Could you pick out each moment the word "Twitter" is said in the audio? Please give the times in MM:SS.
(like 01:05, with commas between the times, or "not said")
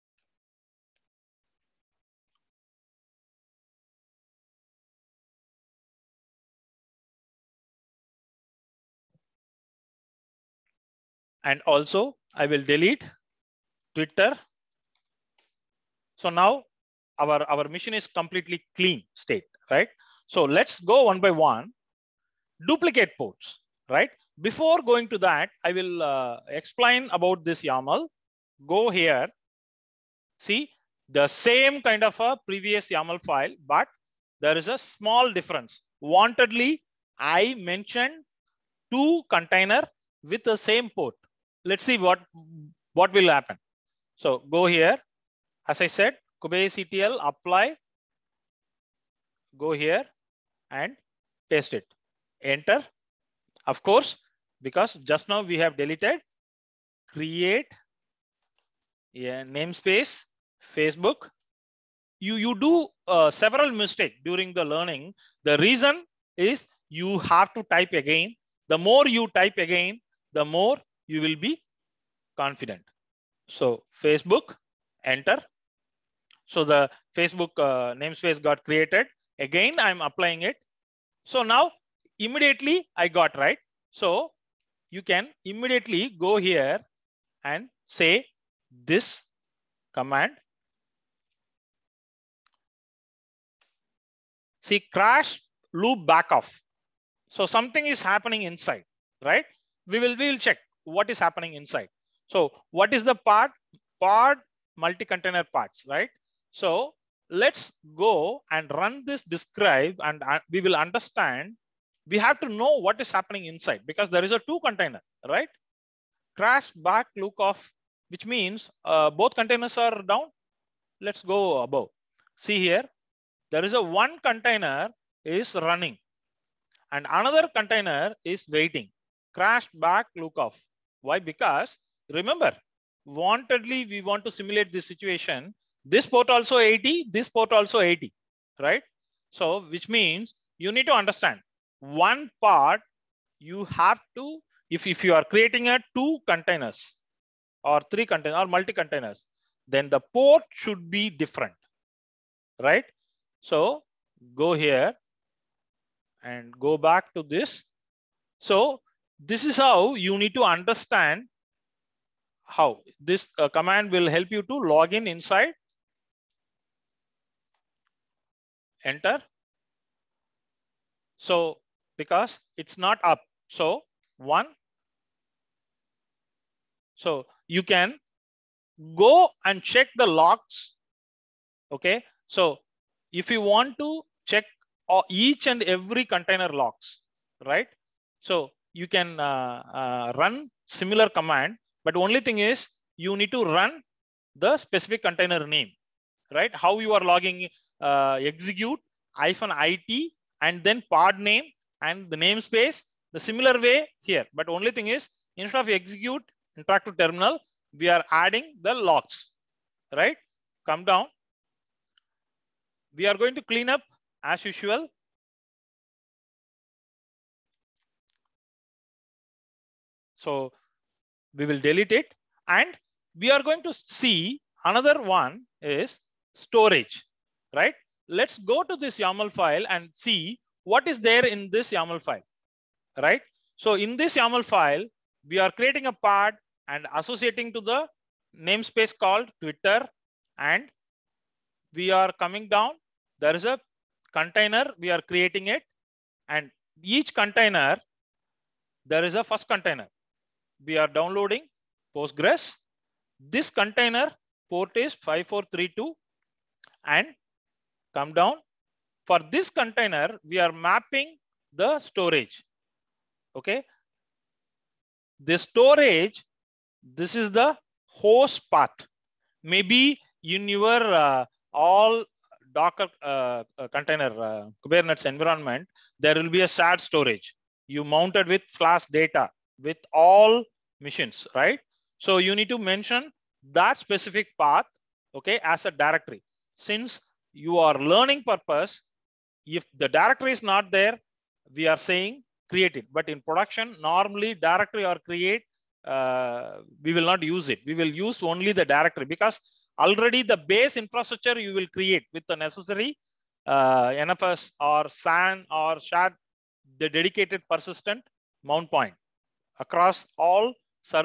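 00:13, 03:59.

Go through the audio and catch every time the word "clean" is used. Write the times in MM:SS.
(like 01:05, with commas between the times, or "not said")
00:18, 03:33.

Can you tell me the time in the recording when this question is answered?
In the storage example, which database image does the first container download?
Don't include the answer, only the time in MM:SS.
04:11.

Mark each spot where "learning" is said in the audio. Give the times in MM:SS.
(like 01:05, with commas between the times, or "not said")
01:04, 04:47.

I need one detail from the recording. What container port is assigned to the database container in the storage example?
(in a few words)
5432.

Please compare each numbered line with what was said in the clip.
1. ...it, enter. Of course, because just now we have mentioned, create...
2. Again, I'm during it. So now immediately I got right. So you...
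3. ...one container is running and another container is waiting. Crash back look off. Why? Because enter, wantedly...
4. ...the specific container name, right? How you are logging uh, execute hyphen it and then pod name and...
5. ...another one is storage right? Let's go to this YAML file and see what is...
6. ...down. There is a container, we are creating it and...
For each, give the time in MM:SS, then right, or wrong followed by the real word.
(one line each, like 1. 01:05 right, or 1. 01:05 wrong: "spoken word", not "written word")
1. 00:51 wrong: "deleted", not "mentioned"
2. 01:19 wrong: "applying", not "during"
3. 02:03 wrong: "remember", not "enter"
4. 03:14 right
5. 03:44 right
6. 04:02 right.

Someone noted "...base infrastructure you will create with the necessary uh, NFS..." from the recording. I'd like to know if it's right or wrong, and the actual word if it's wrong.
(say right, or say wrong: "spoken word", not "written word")
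right.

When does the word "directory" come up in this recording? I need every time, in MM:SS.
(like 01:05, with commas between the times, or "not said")
04:45, 04:49, 04:54, 04:58.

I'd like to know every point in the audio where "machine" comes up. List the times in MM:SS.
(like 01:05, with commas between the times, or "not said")
00:17, 04:40.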